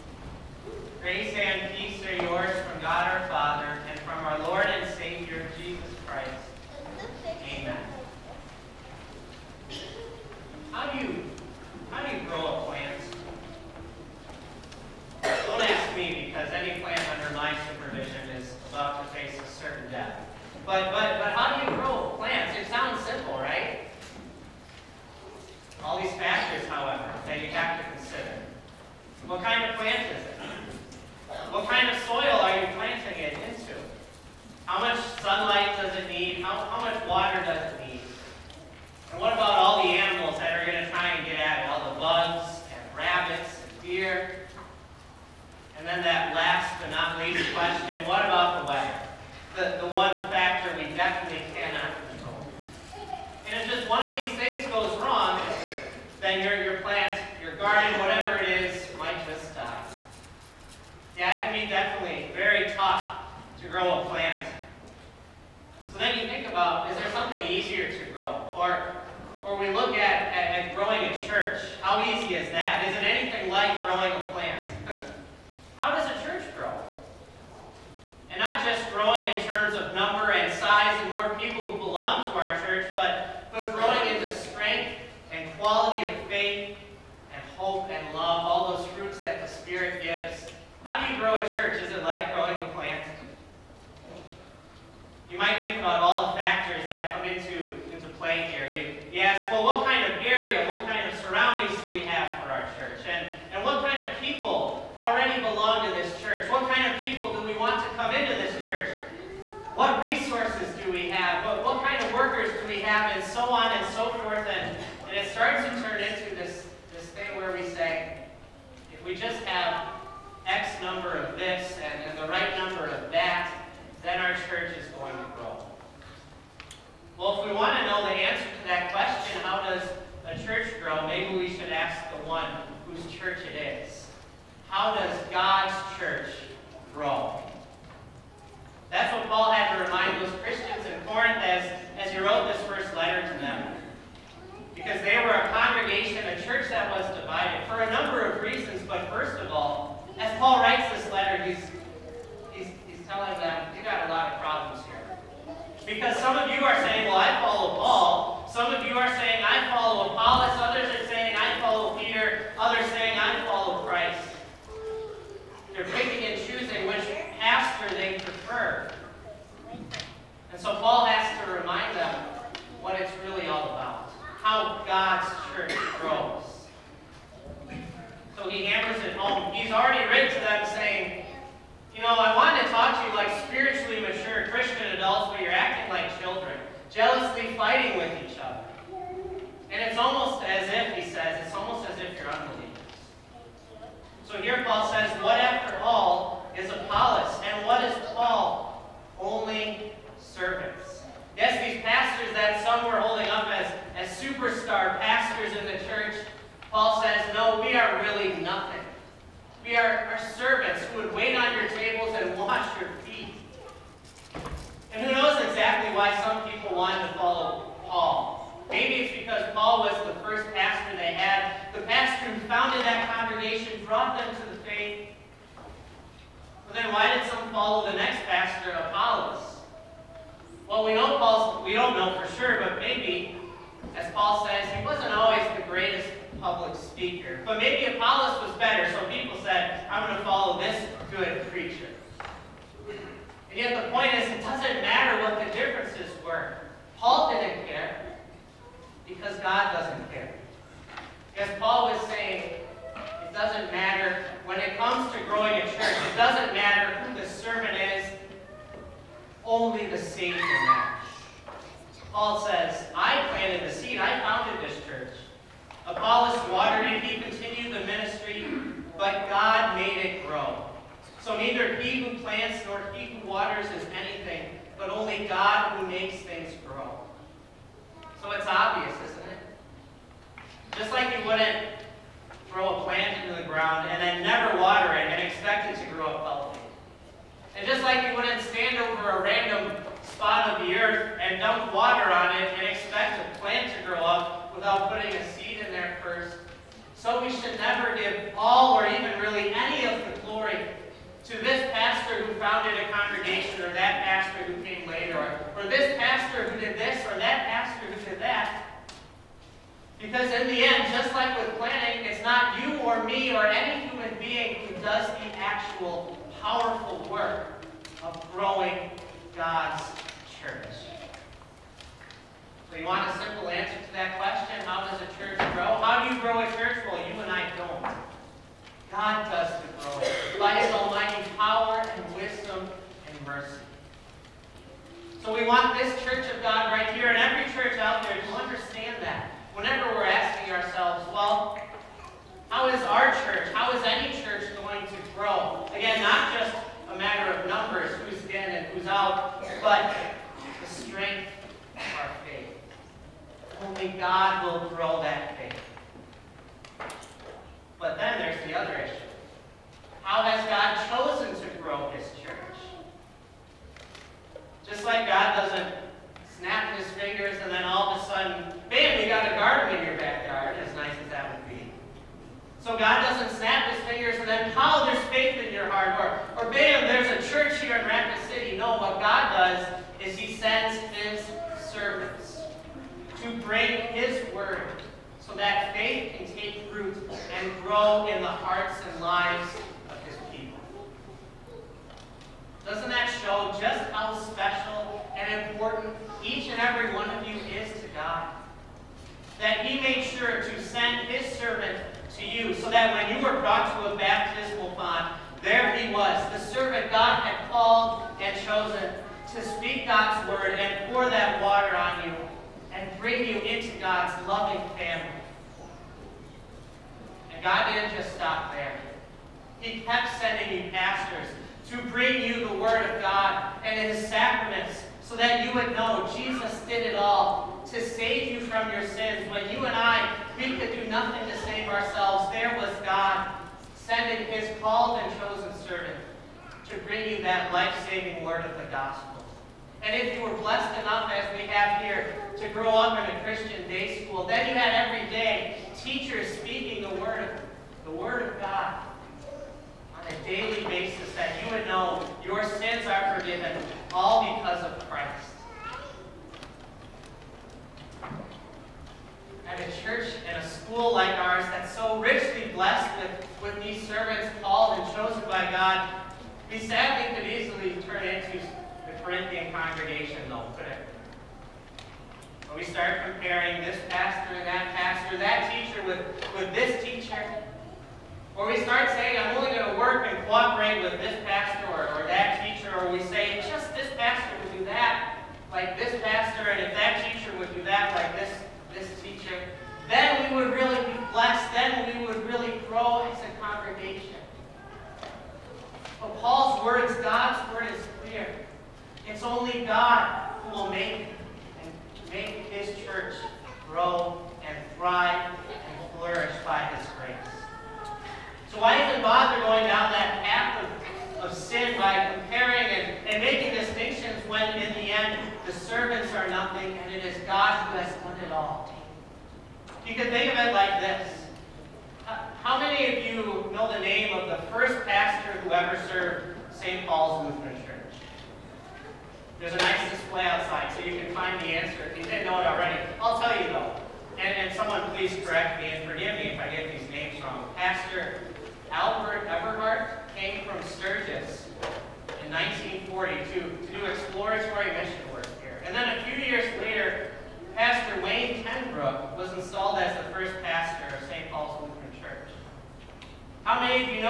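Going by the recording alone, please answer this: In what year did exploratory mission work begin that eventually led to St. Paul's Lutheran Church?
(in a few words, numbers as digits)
1942.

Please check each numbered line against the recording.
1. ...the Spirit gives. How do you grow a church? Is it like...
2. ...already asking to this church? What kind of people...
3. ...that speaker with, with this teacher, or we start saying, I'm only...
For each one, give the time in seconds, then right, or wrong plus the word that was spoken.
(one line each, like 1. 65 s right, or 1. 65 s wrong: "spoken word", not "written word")
1. 89 s right
2. 104 s wrong: "belong", not "asking"
3. 475 s wrong: "teacher", not "speaker".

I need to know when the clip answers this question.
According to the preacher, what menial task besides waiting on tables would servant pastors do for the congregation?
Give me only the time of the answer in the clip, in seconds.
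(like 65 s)
212 s.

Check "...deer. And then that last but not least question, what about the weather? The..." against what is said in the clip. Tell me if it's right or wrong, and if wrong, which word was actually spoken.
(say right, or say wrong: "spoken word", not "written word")
right.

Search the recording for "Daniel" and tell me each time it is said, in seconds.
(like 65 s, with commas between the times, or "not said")
not said.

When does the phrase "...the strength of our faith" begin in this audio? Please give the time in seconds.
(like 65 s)
350 s.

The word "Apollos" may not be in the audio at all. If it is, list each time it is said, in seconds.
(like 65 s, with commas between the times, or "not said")
196 s, 228 s, 237 s, 265 s.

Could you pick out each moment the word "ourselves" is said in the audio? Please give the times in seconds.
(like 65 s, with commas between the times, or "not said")
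340 s, 431 s.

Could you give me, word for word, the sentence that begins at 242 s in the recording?
And yet the point is, it doesn't matter what the differences were.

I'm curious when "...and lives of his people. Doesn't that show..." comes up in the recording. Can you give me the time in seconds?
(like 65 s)
388 s.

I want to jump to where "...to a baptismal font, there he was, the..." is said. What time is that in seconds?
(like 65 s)
403 s.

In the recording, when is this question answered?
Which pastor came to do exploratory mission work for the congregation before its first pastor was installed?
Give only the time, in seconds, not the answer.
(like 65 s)
538 s.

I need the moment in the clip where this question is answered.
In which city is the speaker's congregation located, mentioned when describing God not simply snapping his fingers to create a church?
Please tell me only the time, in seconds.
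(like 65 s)
377 s.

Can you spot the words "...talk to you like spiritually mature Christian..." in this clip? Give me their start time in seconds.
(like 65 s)
182 s.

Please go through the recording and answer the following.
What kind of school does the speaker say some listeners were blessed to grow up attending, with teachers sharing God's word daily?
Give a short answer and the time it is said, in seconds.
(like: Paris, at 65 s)
Christian day school, at 443 s.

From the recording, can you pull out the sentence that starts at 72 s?
Is it anything like growing a plant?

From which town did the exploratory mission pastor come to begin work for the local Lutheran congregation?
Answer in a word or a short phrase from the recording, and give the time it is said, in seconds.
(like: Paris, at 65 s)
Sturgis, at 540 s.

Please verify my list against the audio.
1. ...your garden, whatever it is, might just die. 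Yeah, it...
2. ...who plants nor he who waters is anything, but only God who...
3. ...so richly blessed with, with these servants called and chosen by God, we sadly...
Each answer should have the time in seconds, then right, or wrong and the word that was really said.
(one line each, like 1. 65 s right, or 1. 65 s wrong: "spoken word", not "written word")
1. 57 s right
2. 272 s right
3. 461 s right.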